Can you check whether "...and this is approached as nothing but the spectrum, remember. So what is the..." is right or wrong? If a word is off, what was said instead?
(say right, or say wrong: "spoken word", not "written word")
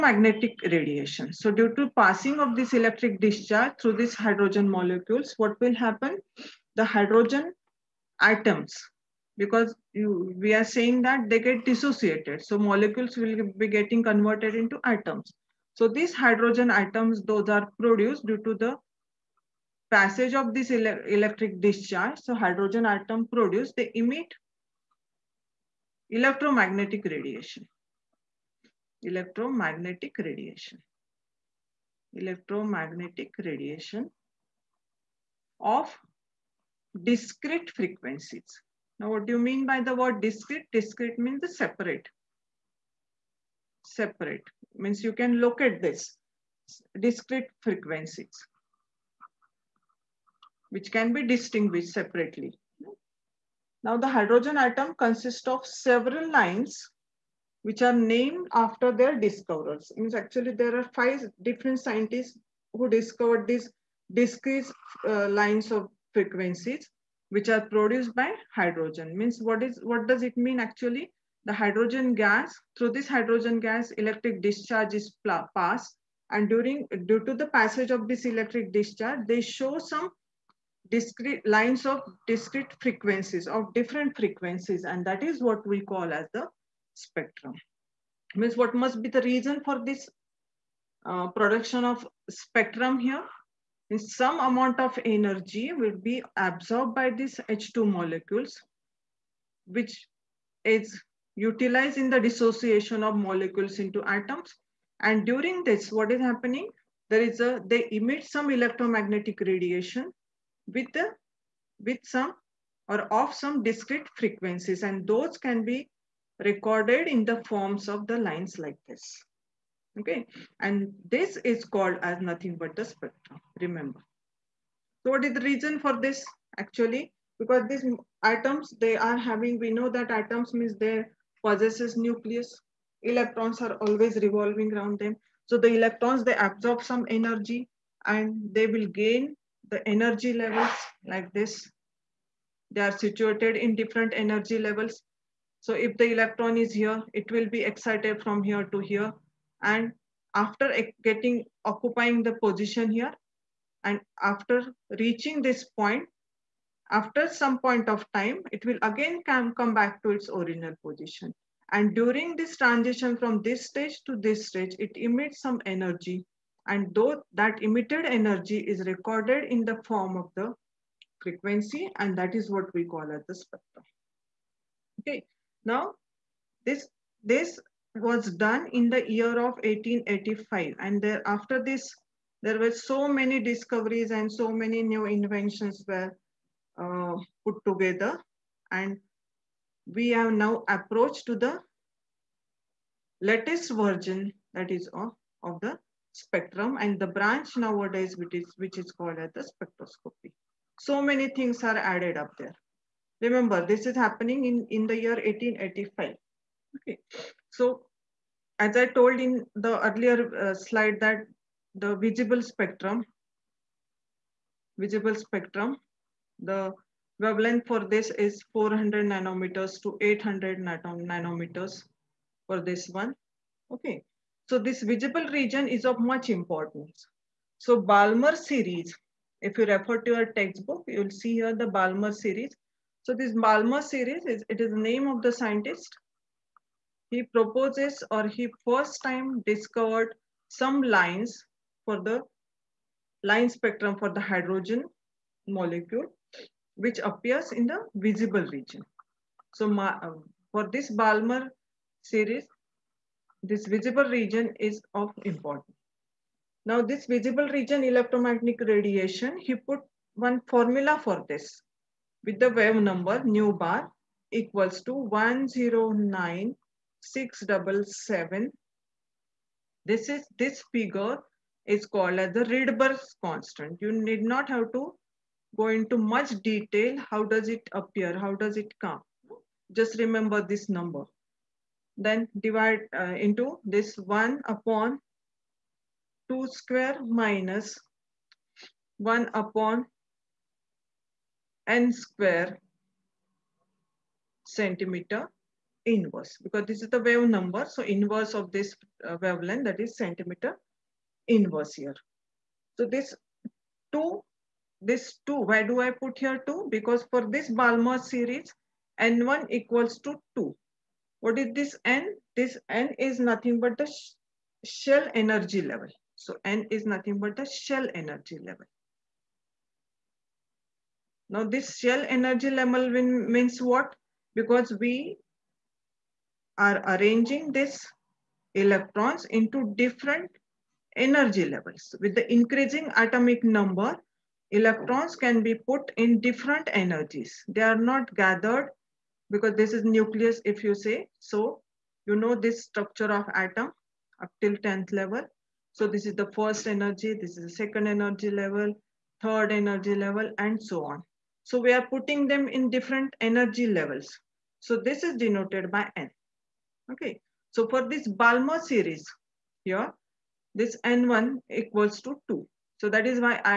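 wrong: "called", not "approached".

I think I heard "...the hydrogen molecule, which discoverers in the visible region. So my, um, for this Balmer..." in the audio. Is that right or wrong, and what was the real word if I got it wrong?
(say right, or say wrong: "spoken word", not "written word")
wrong: "appears", not "discoverers".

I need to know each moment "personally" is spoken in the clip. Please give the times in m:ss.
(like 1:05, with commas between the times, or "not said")
not said.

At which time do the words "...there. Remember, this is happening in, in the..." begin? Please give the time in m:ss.
3:22.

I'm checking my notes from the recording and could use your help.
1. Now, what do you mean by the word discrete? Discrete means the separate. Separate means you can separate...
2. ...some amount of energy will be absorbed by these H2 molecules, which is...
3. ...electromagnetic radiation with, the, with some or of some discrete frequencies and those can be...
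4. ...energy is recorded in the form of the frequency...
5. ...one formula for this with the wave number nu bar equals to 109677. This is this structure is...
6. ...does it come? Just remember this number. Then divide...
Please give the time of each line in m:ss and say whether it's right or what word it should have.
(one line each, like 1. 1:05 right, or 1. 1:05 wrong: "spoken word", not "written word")
1. 0:38 wrong: "locate", not "separate"
2. 1:34 right
3. 1:48 right
4. 2:48 right
5. 4:20 wrong: "figure", not "structure"
6. 4:38 right.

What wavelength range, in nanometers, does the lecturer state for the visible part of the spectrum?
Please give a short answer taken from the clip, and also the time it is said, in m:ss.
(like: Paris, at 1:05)
400 to 800 nanometers, at 3:38.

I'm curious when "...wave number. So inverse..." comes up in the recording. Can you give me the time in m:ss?
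4:56.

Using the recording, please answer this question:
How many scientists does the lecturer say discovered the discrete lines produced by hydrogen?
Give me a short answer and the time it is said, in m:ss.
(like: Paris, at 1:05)
5, at 1:00.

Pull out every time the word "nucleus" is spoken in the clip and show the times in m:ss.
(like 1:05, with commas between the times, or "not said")
2:11, 5:39.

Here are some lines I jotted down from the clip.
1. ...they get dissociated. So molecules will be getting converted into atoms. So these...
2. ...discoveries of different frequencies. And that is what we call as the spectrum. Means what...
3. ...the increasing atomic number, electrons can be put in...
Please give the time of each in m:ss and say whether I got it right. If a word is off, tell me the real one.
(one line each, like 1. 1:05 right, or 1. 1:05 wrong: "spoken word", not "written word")
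1. 0:11 right
2. 1:22 wrong: "frequencies", not "discoveries"
3. 5:32 right.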